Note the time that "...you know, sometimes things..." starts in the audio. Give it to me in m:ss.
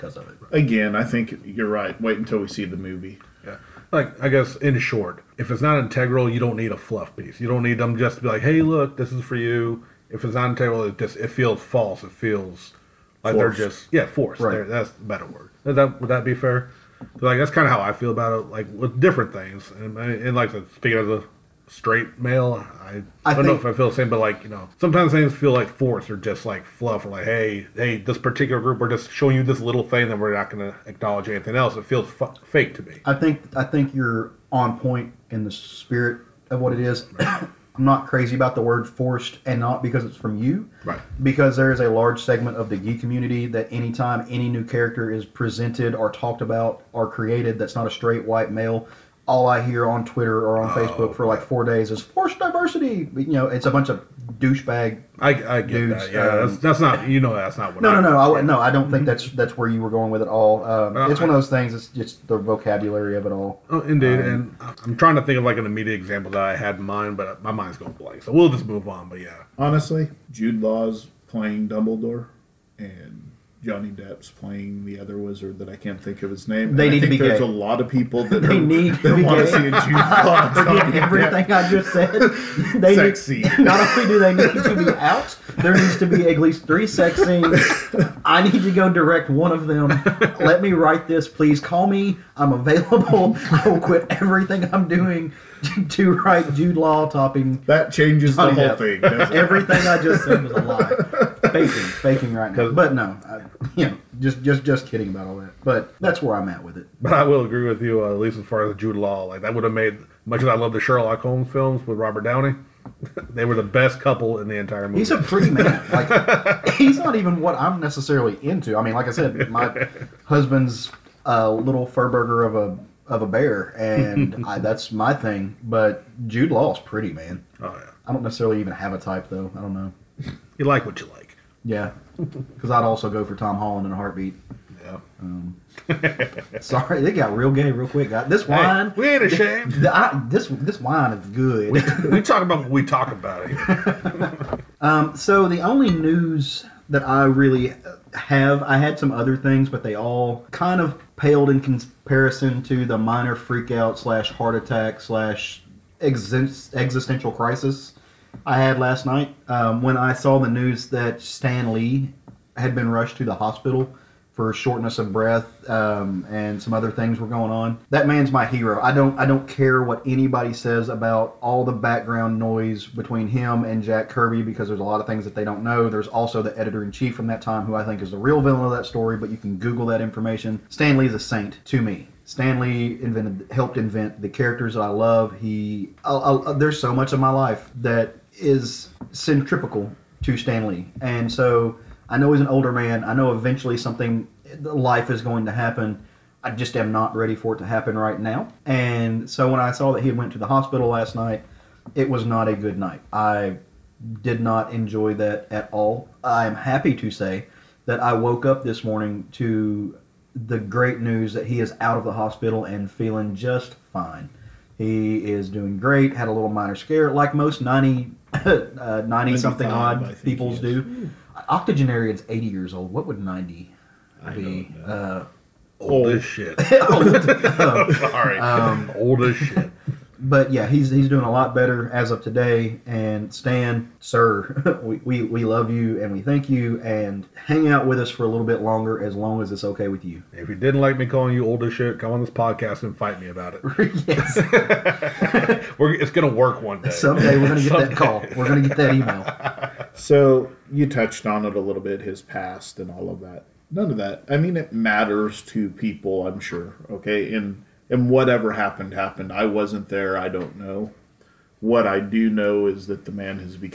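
0:24.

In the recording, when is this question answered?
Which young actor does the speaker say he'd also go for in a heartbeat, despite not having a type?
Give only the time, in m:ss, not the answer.
2:13.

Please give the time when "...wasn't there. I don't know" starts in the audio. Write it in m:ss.
4:19.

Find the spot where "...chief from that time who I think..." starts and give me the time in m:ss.
2:56.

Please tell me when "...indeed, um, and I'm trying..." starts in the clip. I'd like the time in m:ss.
1:03.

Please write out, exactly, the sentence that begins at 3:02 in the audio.
Stan Lee invented, helped invent the characters that I love.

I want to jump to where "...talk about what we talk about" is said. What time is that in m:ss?
2:22.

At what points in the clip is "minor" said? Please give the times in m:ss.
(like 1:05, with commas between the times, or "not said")
2:32, 3:36.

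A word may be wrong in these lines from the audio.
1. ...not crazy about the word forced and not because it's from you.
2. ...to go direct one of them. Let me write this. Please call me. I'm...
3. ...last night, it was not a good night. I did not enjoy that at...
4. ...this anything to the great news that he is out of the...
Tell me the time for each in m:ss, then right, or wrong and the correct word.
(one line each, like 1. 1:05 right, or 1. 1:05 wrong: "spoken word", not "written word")
1. 0:37 right
2. 1:28 right
3. 3:20 right
4. 3:28 wrong: "morning", not "anything".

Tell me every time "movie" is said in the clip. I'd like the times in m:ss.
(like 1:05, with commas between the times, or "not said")
0:02, 1:54.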